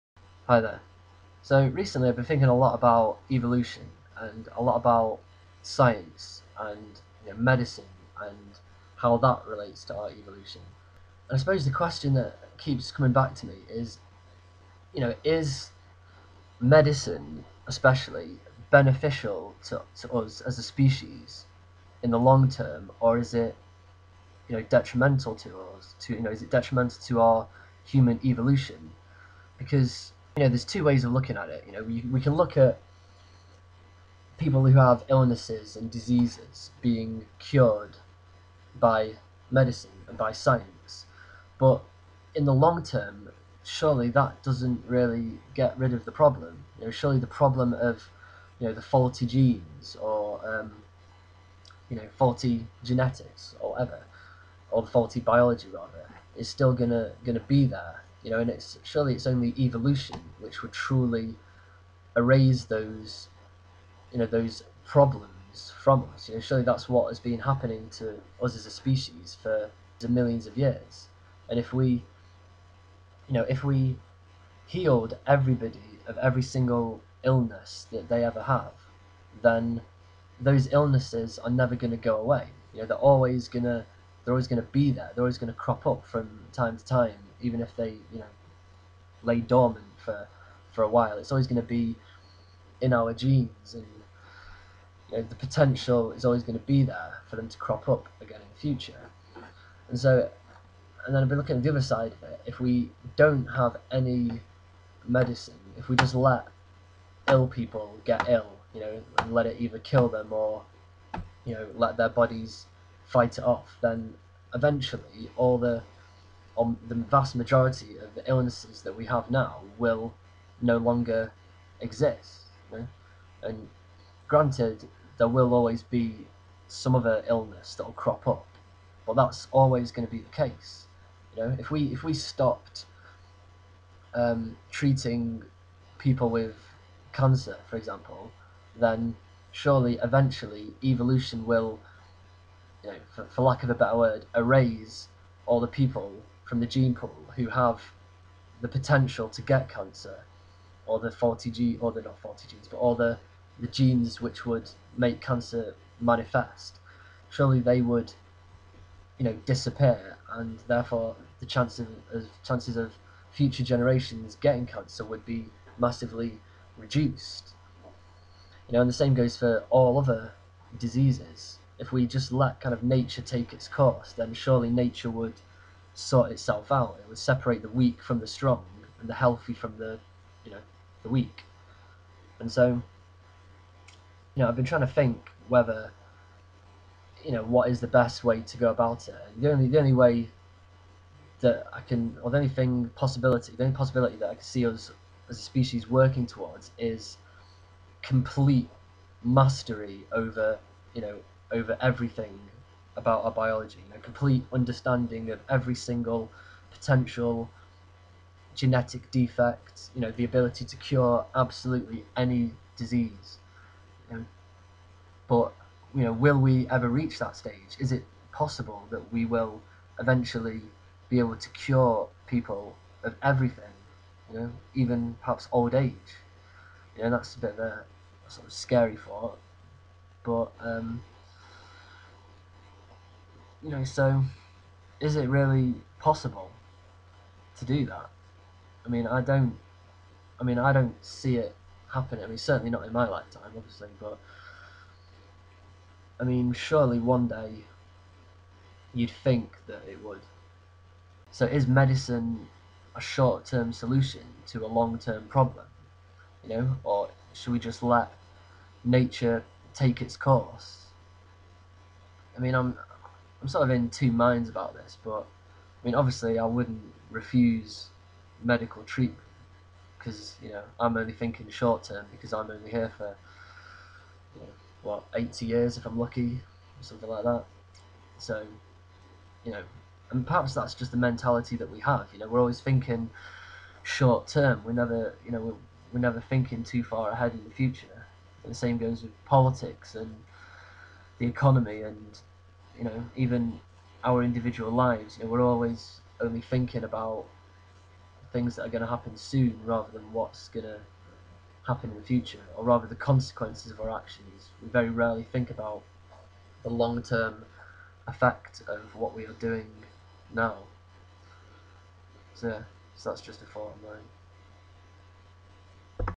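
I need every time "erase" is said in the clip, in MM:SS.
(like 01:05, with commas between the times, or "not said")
01:02, 02:24.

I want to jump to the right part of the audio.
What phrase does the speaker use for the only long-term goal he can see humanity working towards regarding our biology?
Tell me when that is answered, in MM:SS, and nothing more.
03:18.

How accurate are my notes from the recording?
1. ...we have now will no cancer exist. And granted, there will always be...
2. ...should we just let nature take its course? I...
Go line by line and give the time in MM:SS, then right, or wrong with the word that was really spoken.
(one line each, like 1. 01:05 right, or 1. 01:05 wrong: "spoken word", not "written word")
1. 01:58 wrong: "longer", not "cancer"
2. 04:17 right.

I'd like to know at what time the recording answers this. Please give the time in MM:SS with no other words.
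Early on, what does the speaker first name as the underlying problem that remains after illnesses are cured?
00:48.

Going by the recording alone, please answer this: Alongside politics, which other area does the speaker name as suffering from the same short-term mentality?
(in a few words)
the economy.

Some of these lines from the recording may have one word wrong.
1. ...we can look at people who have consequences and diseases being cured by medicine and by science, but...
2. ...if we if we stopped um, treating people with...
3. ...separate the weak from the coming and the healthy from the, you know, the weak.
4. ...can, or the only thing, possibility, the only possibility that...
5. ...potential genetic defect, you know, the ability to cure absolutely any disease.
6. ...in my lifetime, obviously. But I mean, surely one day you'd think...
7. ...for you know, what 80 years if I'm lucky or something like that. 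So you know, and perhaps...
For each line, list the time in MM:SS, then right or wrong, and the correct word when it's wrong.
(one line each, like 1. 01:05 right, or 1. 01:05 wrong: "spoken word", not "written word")
1. 00:32 wrong: "illnesses", not "consequences"
2. 02:11 right
3. 02:57 wrong: "strong", not "coming"
4. 03:11 right
5. 03:26 right
6. 04:02 right
7. 04:32 right.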